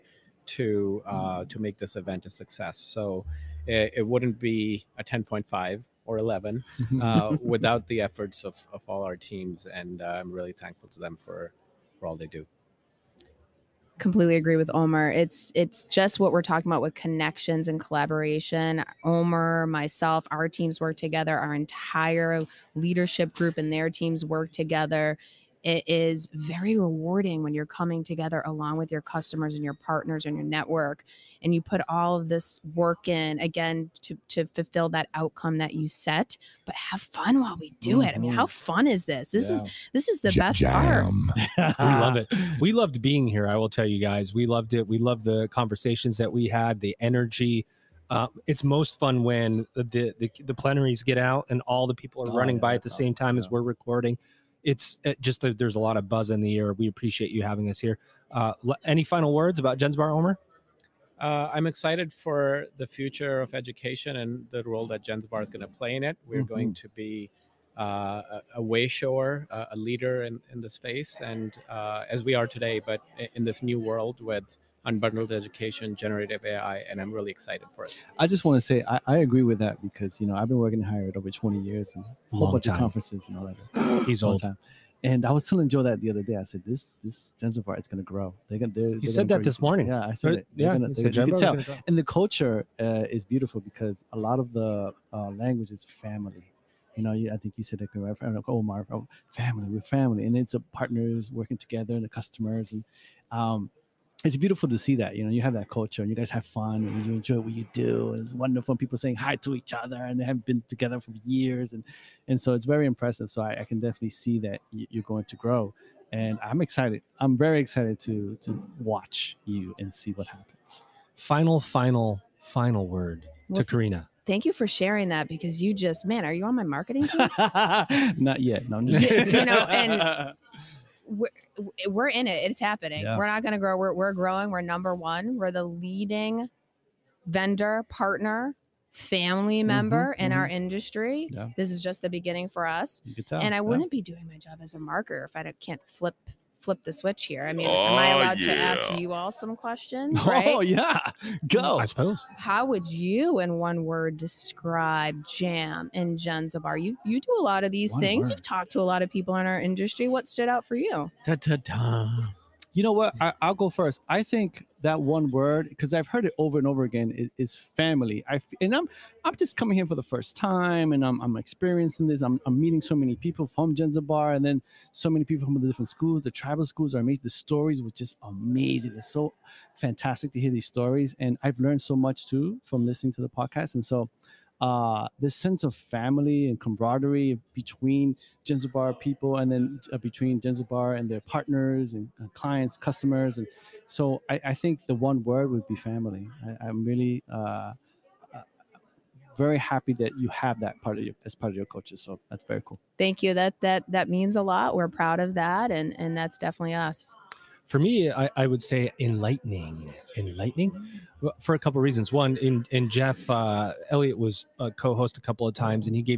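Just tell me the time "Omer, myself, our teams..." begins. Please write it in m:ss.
0:19.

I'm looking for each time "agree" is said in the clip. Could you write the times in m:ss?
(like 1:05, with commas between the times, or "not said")
0:14, 1:19.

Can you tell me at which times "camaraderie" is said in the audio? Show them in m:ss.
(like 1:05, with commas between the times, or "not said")
3:06.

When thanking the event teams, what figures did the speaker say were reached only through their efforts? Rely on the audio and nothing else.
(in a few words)
10.5 or 11.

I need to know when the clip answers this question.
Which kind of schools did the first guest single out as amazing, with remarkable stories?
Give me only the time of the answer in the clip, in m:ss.
2:56.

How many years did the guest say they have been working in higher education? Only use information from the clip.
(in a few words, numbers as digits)
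over 20 years.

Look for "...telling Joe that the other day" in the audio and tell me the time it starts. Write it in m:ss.
1:25.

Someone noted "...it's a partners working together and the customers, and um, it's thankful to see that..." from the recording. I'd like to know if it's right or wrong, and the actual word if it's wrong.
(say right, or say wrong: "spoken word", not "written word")
wrong: "beautiful", not "thankful".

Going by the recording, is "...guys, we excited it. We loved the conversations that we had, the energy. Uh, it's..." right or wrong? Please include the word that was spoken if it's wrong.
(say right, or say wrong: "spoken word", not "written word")
wrong: "loved", not "excited".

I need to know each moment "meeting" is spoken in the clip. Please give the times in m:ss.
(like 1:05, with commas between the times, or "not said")
2:52.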